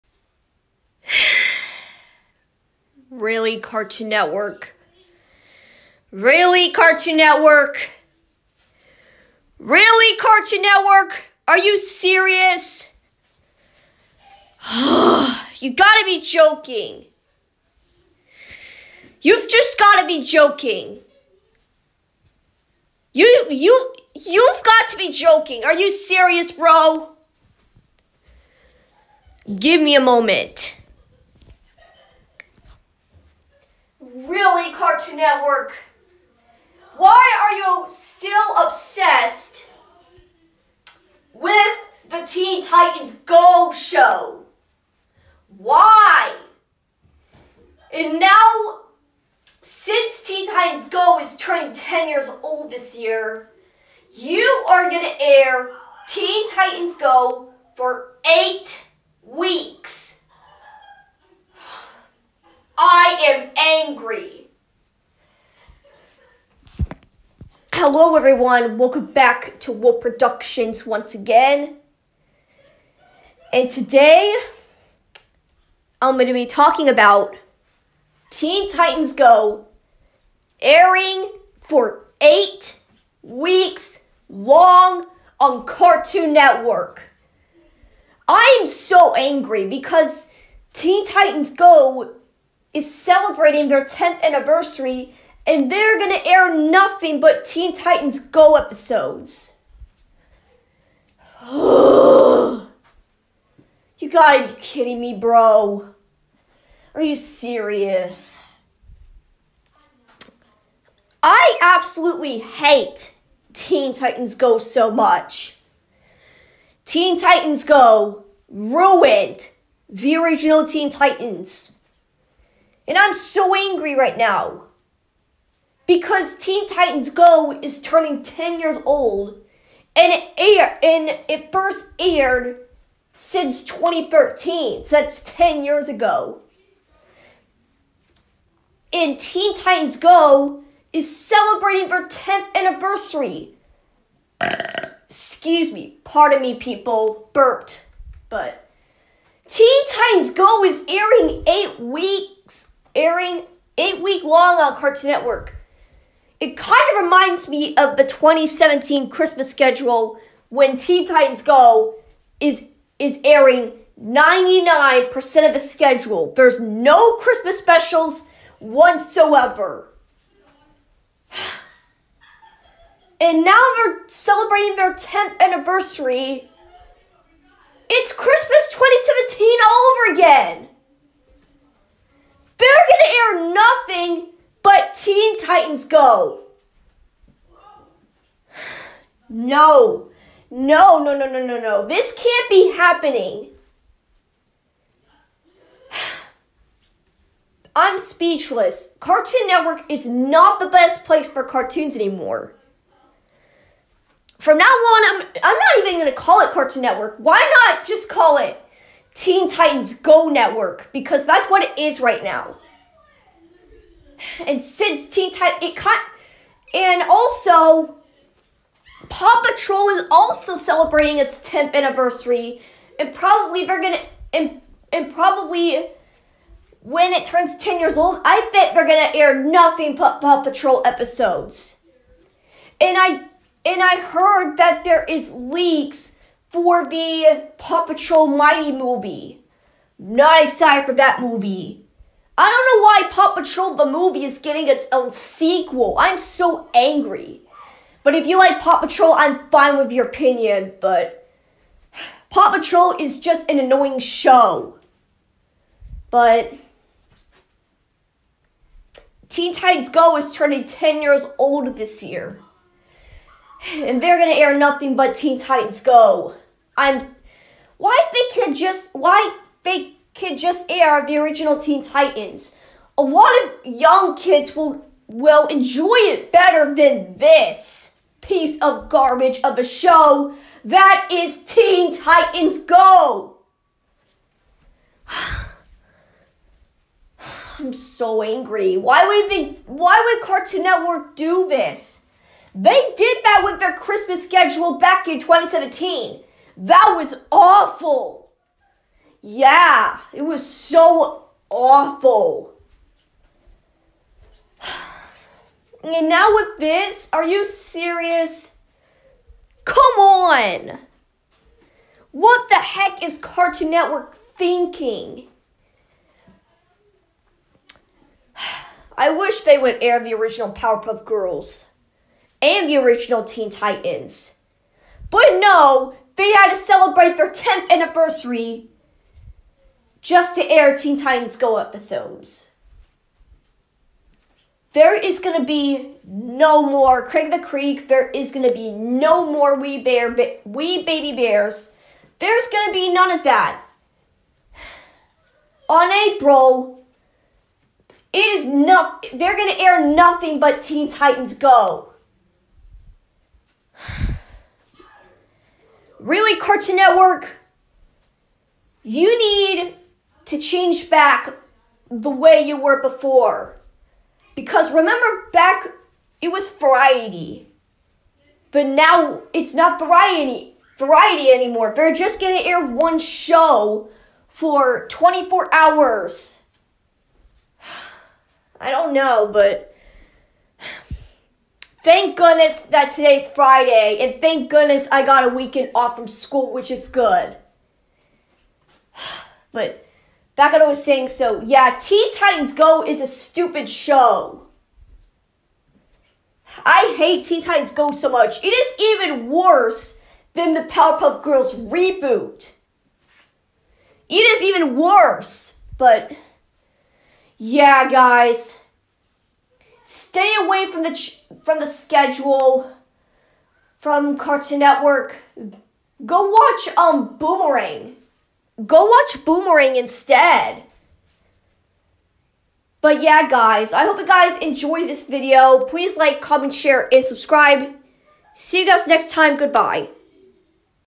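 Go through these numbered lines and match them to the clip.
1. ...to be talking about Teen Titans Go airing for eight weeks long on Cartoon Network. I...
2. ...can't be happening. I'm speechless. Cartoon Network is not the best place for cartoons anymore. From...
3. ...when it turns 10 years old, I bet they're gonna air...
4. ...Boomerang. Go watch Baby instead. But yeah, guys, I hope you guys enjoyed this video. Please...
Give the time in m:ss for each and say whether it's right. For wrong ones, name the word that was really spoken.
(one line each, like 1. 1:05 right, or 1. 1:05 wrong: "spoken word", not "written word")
1. 1:16 right
2. 3:12 right
3. 3:46 right
4. 6:57 wrong: "Boomerang", not "Baby".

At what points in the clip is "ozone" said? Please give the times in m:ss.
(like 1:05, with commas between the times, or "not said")
not said.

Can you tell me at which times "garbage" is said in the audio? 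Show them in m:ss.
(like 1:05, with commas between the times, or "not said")
4:38.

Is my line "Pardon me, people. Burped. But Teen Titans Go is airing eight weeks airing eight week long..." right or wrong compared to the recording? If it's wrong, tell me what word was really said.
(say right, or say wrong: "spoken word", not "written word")
right.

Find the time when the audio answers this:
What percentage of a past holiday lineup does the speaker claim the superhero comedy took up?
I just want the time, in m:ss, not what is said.
2:44.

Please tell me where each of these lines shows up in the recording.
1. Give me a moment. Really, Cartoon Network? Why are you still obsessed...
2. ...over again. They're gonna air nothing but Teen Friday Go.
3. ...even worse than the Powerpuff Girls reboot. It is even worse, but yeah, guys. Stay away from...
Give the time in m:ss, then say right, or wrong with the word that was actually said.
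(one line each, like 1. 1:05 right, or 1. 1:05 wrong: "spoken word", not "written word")
1. 0:29 right
2. 2:59 wrong: "Titans", not "Friday"
3. 6:38 right.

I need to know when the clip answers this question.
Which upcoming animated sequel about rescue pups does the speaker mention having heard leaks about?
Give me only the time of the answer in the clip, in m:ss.
3:57.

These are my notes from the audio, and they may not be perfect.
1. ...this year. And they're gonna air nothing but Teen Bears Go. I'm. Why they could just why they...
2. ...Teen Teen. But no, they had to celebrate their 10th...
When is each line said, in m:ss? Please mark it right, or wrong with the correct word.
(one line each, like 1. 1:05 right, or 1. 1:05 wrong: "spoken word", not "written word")
1. 4:21 wrong: "Titans", not "Bears"
2. 5:23 wrong: "Titans", not "Teen".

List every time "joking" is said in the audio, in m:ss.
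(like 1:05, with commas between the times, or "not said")
0:16, 0:20, 0:25.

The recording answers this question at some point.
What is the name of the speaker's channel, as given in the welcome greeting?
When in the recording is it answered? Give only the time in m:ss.
1:09.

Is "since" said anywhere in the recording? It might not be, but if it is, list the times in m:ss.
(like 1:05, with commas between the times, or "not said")
0:49, 2:13, 3:34.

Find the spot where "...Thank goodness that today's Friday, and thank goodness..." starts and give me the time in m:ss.
6:21.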